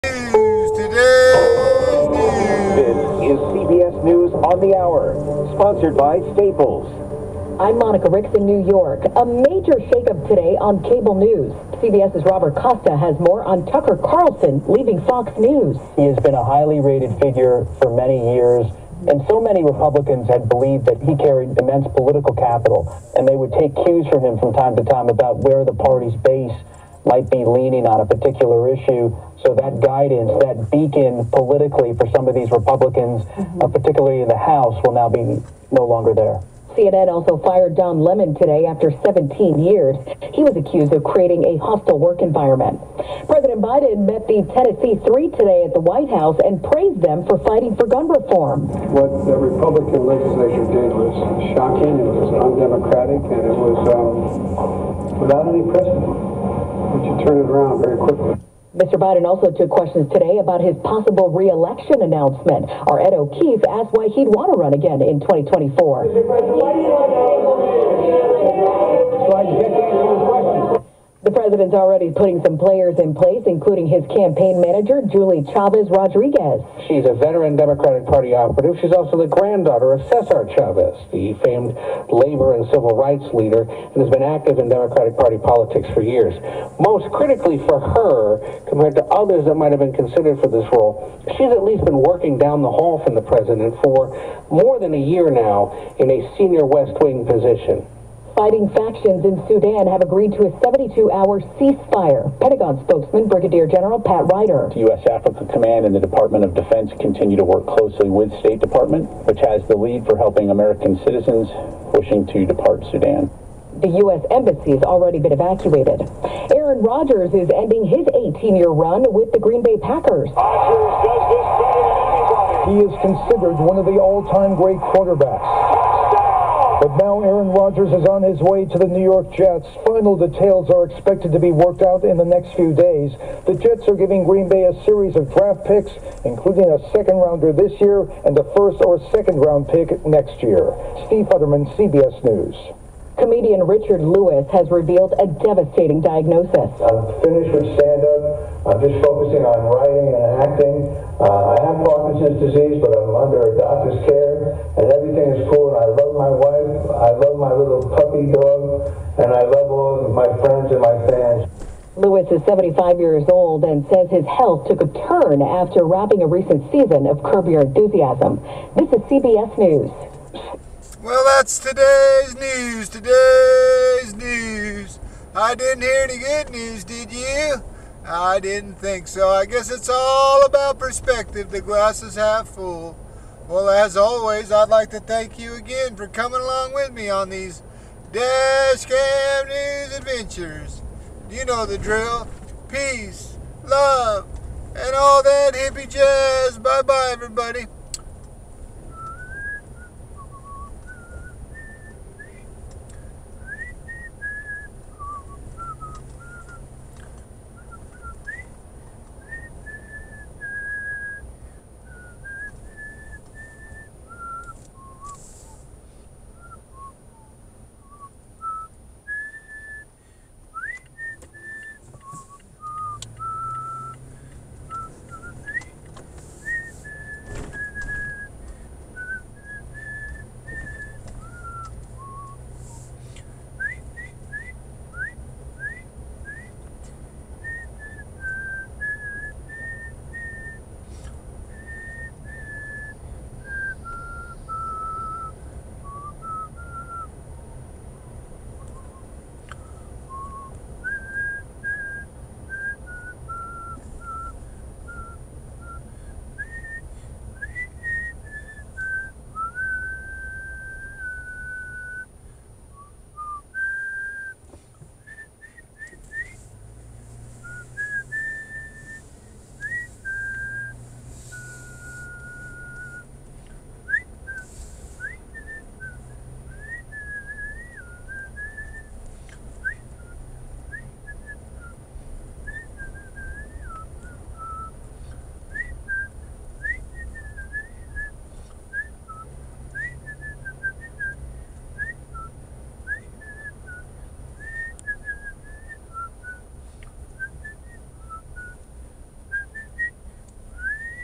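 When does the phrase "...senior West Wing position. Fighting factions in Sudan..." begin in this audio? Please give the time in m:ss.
1:36.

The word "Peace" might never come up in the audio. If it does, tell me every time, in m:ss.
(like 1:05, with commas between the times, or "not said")
3:12.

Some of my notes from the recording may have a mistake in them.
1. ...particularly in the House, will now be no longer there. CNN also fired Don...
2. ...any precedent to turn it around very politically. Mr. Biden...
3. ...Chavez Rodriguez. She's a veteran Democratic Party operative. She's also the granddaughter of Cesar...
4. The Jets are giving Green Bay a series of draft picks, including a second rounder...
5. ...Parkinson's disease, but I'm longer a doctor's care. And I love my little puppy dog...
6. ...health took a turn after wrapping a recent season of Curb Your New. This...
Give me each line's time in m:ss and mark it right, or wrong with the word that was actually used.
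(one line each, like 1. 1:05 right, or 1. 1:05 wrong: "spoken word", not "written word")
1. 0:33 right
2. 0:55 wrong: "quickly", not "politically"
3. 1:15 right
4. 2:13 right
5. 2:31 wrong: "under", not "longer"
6. 2:44 wrong: "Enthusiasm", not "New".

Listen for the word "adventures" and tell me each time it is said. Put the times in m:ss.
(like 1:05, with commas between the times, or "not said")
3:09.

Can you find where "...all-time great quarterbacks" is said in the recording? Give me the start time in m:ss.
2:03.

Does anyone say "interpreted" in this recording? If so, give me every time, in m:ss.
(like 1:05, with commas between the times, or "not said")
not said.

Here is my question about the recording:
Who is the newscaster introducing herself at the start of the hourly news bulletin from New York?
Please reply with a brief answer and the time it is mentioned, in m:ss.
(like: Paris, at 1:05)
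Monica Ricks, at 0:07.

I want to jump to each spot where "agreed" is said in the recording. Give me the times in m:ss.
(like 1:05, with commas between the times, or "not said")
1:40.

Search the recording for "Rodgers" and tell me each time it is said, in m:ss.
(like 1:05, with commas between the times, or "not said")
1:56, 2:07.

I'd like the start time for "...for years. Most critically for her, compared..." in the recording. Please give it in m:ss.
1:25.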